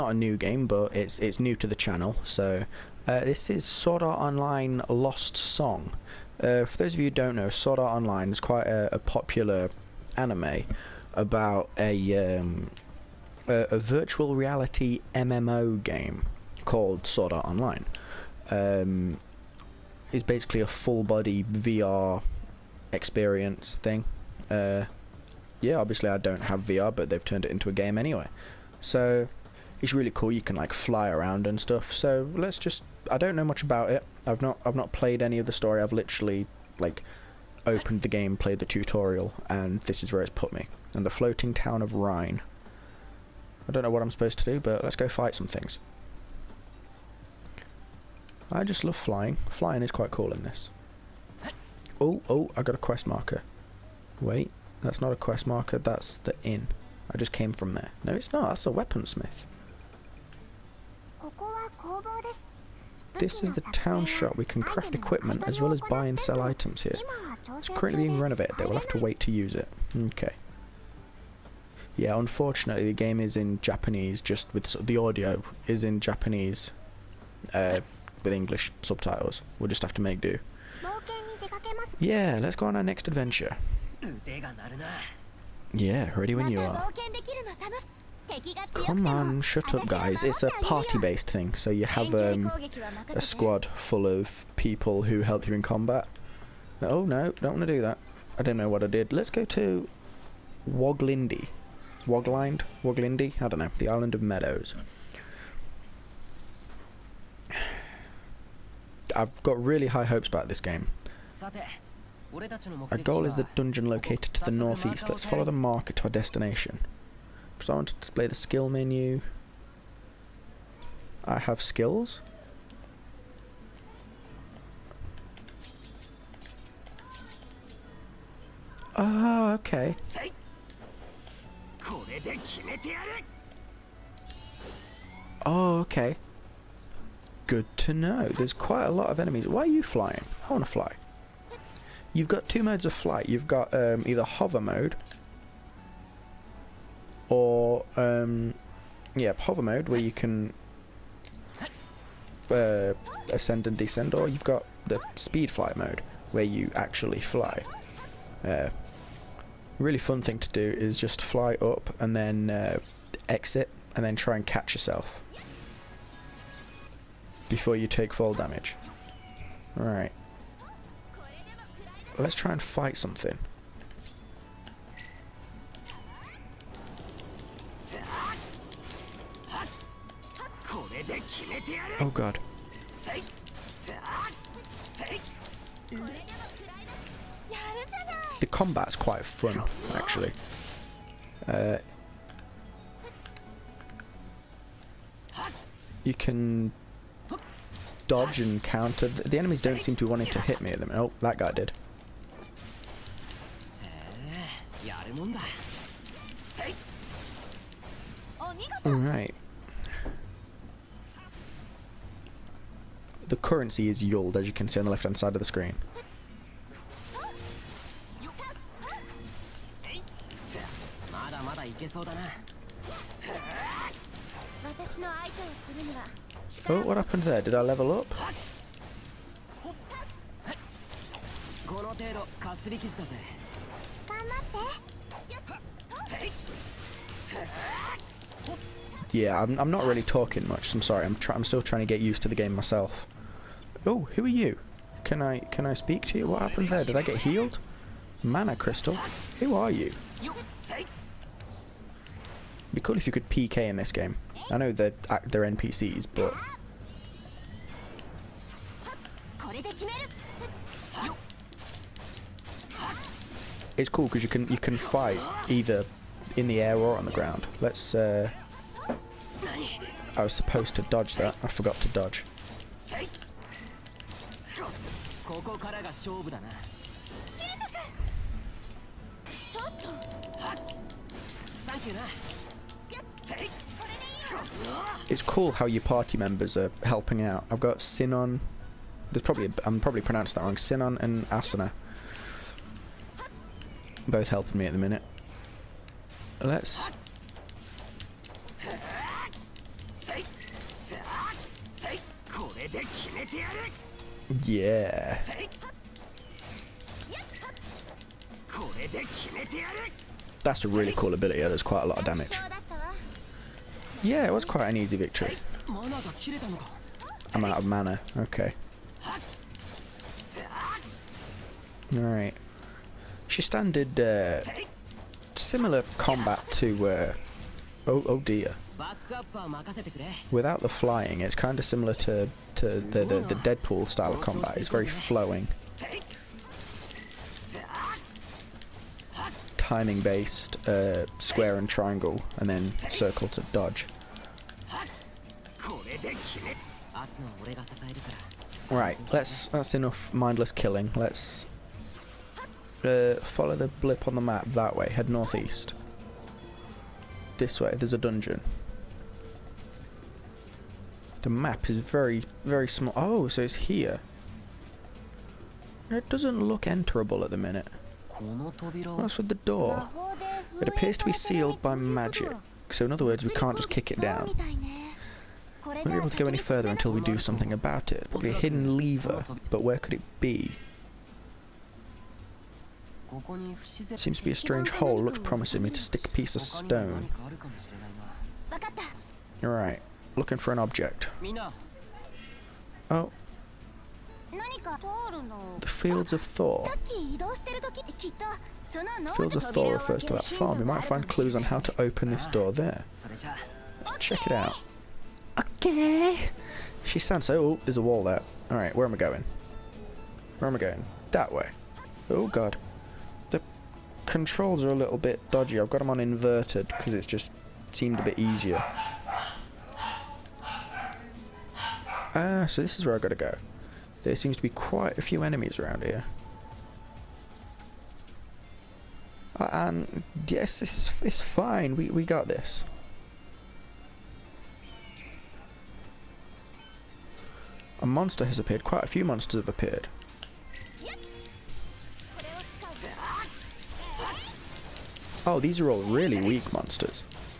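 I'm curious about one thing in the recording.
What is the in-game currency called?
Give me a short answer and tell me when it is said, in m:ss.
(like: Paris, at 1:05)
Yield, at 3:34.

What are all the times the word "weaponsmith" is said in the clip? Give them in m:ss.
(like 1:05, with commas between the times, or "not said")
0:58.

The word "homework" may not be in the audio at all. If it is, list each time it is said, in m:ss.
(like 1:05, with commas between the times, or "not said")
not said.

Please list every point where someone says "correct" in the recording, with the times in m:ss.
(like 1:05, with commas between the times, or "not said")
not said.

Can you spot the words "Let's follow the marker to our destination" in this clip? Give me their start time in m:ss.
1:55.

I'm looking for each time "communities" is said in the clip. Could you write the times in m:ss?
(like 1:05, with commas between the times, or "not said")
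not said.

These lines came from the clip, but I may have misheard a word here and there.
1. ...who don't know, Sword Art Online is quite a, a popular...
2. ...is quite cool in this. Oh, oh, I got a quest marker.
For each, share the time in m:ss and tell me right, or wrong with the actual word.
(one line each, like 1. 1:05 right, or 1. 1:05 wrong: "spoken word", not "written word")
1. 0:07 right
2. 0:49 right.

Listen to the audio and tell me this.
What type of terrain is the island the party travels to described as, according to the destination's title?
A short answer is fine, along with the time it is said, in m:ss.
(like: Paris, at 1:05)
Meadows, at 1:43.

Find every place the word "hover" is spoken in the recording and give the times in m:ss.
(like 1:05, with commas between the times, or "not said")
2:24, 2:29.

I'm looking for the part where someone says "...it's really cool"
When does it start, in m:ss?
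0:29.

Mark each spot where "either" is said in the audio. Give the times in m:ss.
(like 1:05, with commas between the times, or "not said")
2:24, 4:25.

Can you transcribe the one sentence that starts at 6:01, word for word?
The map is very, very small.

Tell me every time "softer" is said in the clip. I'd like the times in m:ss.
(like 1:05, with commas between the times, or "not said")
not said.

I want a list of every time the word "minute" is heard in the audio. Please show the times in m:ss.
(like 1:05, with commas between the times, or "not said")
4:54, 6:07.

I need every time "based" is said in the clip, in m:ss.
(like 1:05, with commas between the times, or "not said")
1:30, 5:40.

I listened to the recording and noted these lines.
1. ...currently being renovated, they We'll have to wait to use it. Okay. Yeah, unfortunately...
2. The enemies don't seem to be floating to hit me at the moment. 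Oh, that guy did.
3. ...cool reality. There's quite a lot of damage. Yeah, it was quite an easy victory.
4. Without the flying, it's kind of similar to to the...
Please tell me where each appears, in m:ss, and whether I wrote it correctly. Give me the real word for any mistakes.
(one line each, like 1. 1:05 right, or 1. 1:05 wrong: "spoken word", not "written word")
1. 1:07 right
2. 3:19 wrong: "wanting", not "floating"
3. 5:10 wrong: "ability", not "reality"
4. 5:30 right.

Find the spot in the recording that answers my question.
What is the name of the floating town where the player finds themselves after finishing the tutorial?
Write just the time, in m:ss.
0:41.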